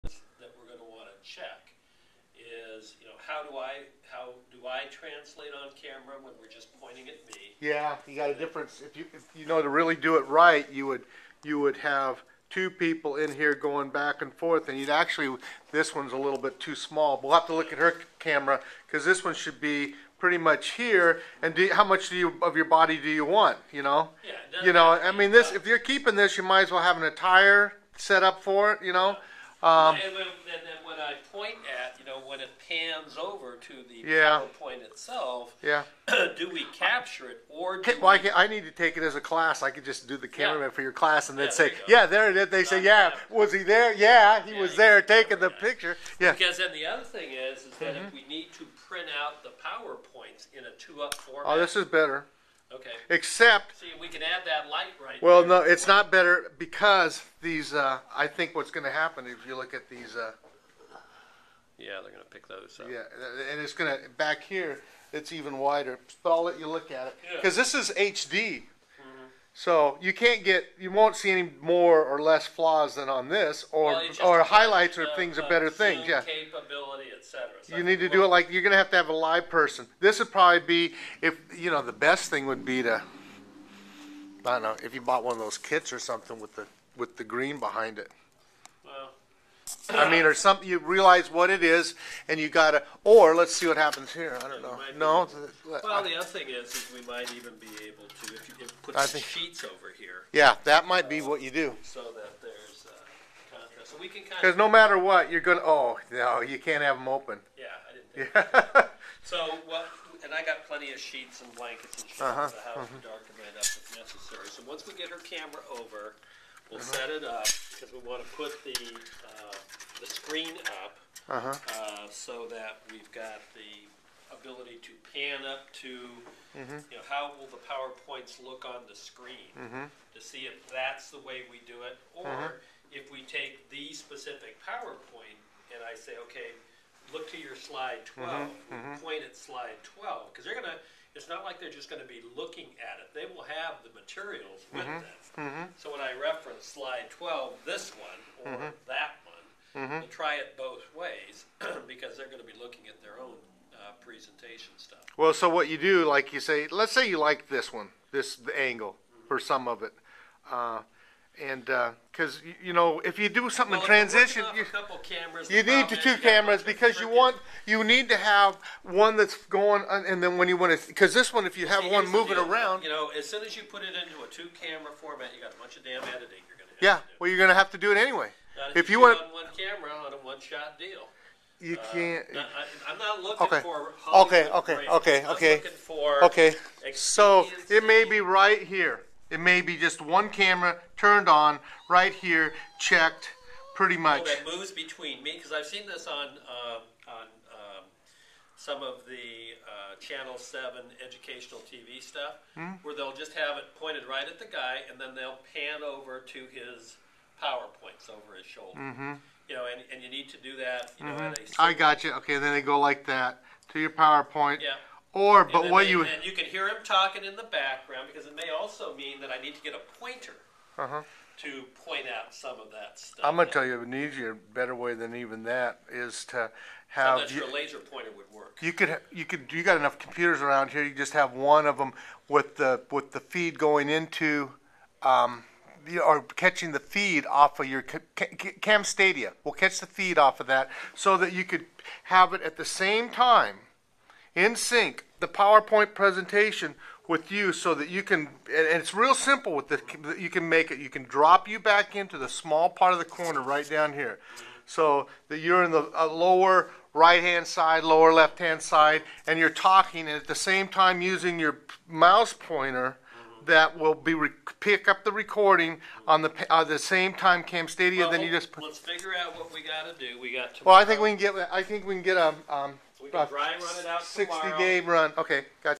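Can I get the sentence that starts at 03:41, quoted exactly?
to point out some of that stuff.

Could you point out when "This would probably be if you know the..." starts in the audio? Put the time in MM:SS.
01:19.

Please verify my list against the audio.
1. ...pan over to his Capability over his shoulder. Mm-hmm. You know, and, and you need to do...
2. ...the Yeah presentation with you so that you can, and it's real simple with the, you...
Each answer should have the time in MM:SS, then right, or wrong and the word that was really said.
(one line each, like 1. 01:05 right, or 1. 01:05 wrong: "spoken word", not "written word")
1. 03:25 wrong: "PowerPoints", not "Capability"
2. 04:05 wrong: "PowerPoint", not "Yeah".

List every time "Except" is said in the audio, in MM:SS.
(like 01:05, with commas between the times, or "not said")
00:53.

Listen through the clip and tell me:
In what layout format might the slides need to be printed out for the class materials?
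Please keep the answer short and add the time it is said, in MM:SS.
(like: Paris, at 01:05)
two-up, at 00:50.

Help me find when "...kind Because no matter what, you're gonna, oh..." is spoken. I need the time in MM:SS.
01:44.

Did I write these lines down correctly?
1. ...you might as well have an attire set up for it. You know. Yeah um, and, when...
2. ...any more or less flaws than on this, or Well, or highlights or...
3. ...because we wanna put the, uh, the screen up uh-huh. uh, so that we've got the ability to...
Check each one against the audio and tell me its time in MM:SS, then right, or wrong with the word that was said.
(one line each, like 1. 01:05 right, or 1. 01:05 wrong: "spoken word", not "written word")
1. 00:26 right
2. 01:11 right
3. 01:57 right.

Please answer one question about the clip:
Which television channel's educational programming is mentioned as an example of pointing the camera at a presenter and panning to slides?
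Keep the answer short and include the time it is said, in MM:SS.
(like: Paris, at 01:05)
Channel Seven, at 03:19.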